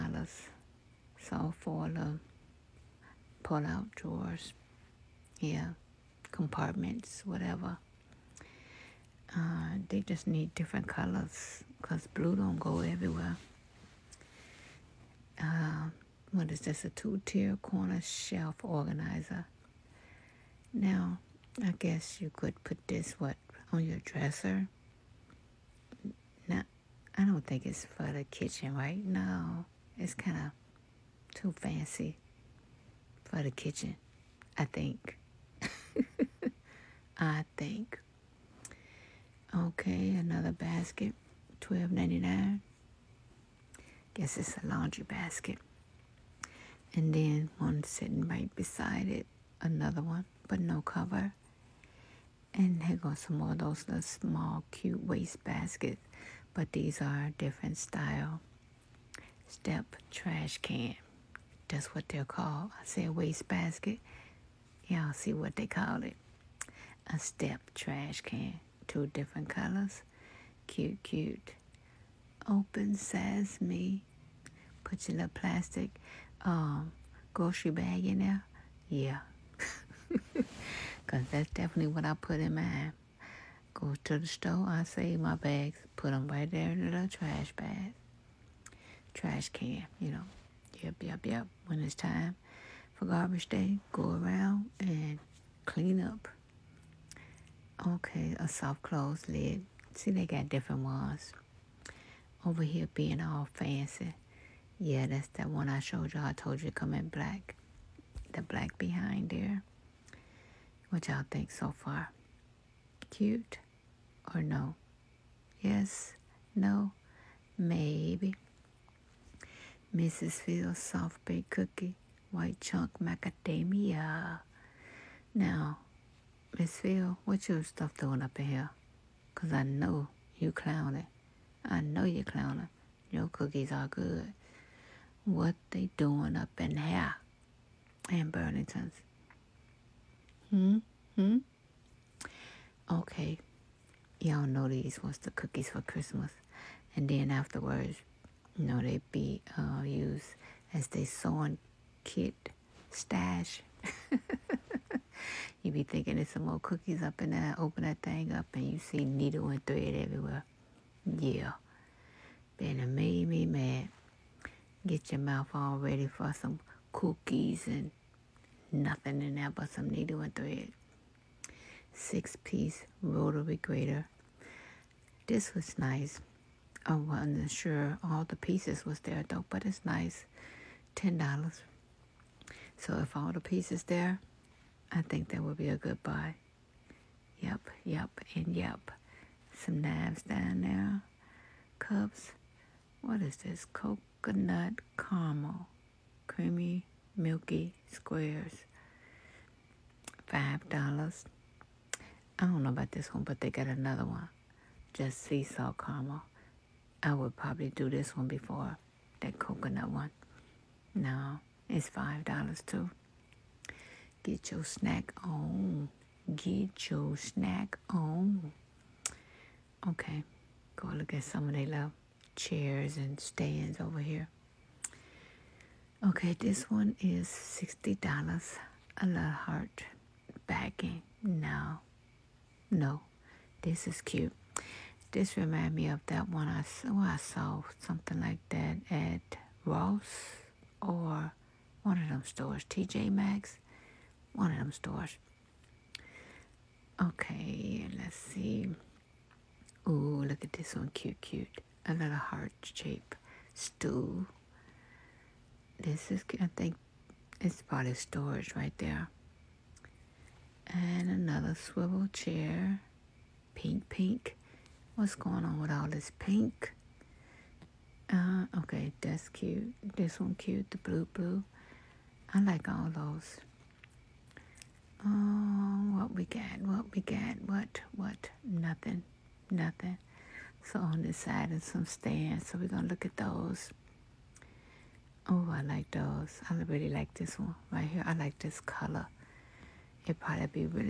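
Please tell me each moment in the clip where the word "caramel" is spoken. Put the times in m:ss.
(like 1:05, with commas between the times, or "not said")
3:14, 3:25.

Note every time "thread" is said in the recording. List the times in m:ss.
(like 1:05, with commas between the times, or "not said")
2:39, 2:50.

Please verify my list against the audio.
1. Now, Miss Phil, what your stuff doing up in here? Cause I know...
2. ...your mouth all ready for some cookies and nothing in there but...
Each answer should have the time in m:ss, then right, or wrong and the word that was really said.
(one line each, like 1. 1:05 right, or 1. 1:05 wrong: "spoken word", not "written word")
1. 2:05 right
2. 2:45 right.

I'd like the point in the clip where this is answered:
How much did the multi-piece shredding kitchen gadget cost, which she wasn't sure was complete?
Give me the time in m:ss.
3:00.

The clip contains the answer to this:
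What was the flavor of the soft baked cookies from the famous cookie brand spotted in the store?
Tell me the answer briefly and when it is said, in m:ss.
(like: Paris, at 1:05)
White chunk macadamia, at 2:02.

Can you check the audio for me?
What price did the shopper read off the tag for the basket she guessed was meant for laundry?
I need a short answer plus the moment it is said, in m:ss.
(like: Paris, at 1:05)
$12.99, at 0:41.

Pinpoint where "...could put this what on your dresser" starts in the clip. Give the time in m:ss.
0:22.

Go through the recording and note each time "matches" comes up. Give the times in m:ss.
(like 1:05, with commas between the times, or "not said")
not said.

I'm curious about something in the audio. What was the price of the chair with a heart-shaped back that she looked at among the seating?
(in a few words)
$60.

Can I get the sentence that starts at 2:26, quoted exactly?
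And then afterwards, you know, they be uh, used as they sewing kit stash.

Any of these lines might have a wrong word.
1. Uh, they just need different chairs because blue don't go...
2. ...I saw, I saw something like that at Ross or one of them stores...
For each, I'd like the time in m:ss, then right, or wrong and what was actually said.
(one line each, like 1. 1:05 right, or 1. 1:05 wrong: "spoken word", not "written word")
1. 0:09 wrong: "colors", not "chairs"
2. 3:56 right.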